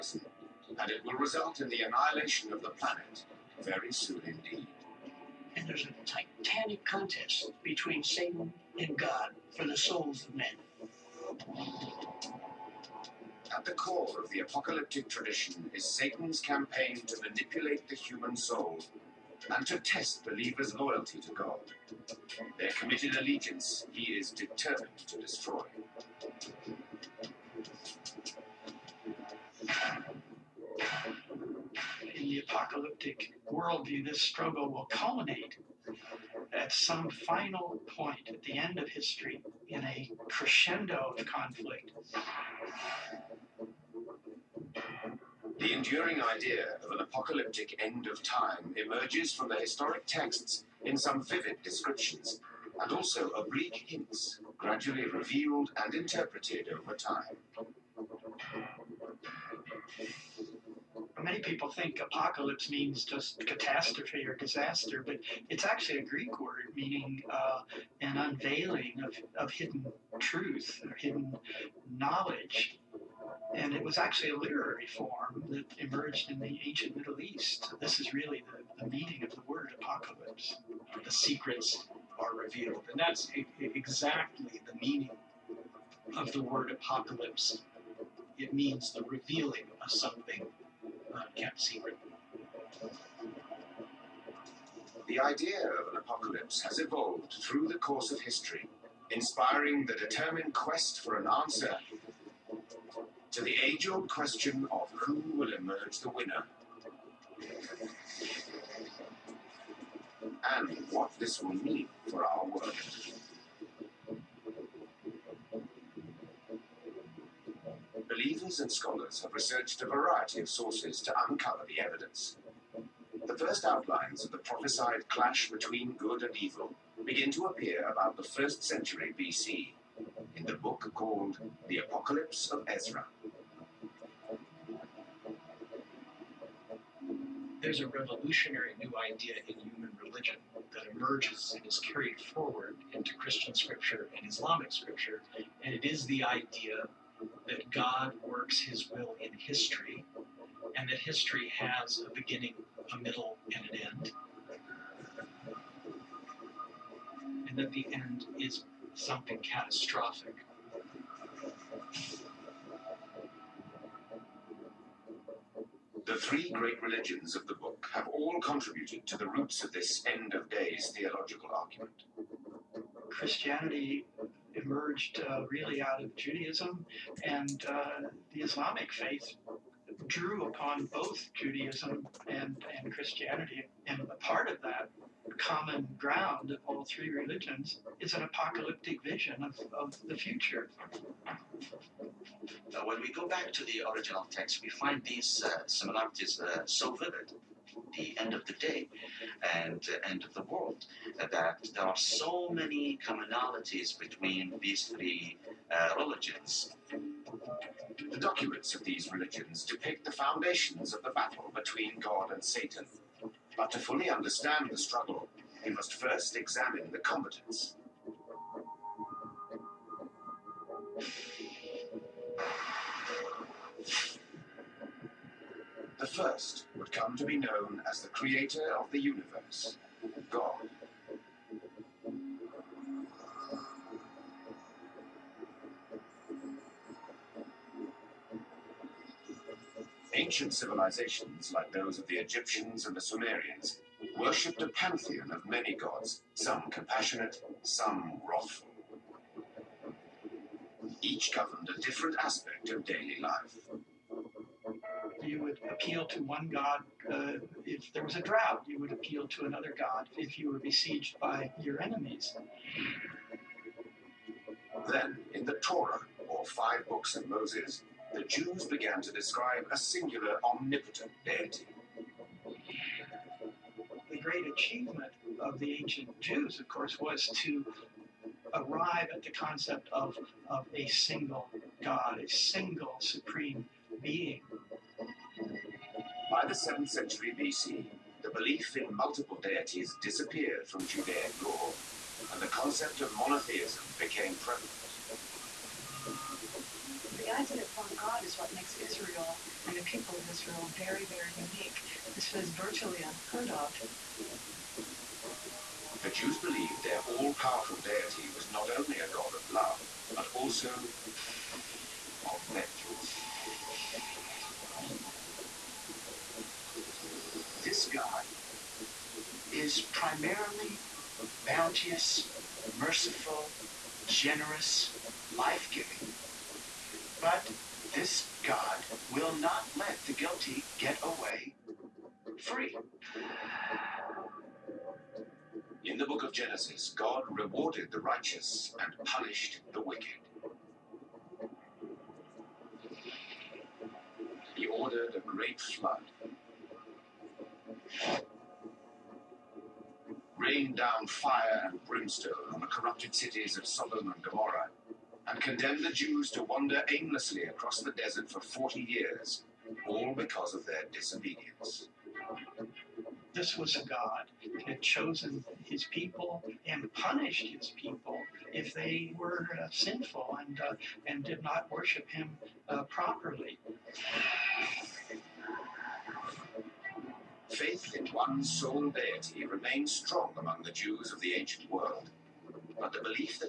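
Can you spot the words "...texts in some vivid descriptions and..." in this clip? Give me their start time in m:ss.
0:50.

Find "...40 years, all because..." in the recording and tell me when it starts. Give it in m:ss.
5:58.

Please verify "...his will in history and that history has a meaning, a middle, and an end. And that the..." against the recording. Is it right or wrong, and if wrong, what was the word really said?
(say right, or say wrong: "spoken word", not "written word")
wrong: "beginning", not "meaning".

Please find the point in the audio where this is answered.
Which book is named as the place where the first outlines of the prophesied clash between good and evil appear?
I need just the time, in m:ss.
2:11.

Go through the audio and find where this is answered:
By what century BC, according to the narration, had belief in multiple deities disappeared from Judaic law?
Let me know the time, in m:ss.
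4:46.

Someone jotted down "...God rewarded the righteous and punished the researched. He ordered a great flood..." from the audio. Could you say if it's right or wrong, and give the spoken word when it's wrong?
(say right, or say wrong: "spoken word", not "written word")
wrong: "wicked", not "researched".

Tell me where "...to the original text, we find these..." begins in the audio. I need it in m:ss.
3:13.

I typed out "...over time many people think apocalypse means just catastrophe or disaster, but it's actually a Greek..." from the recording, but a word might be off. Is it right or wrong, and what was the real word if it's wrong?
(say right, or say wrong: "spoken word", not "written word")
right.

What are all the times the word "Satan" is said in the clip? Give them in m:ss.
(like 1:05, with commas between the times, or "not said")
0:08, 0:15, 3:32.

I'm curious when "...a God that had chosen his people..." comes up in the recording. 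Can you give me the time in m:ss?
6:03.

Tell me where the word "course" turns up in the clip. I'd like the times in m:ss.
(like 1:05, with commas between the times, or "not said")
1:37, 4:36.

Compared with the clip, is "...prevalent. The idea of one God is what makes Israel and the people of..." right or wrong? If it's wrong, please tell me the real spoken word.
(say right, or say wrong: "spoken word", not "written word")
right.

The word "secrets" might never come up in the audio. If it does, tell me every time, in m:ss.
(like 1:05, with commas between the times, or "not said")
1:21, 1:31.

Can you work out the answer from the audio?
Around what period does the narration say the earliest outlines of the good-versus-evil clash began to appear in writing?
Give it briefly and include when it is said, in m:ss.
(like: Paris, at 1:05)
1st century BC, at 2:08.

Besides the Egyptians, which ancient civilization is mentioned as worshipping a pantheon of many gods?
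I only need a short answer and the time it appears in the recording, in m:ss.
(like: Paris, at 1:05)
Sumerians, at 4:03.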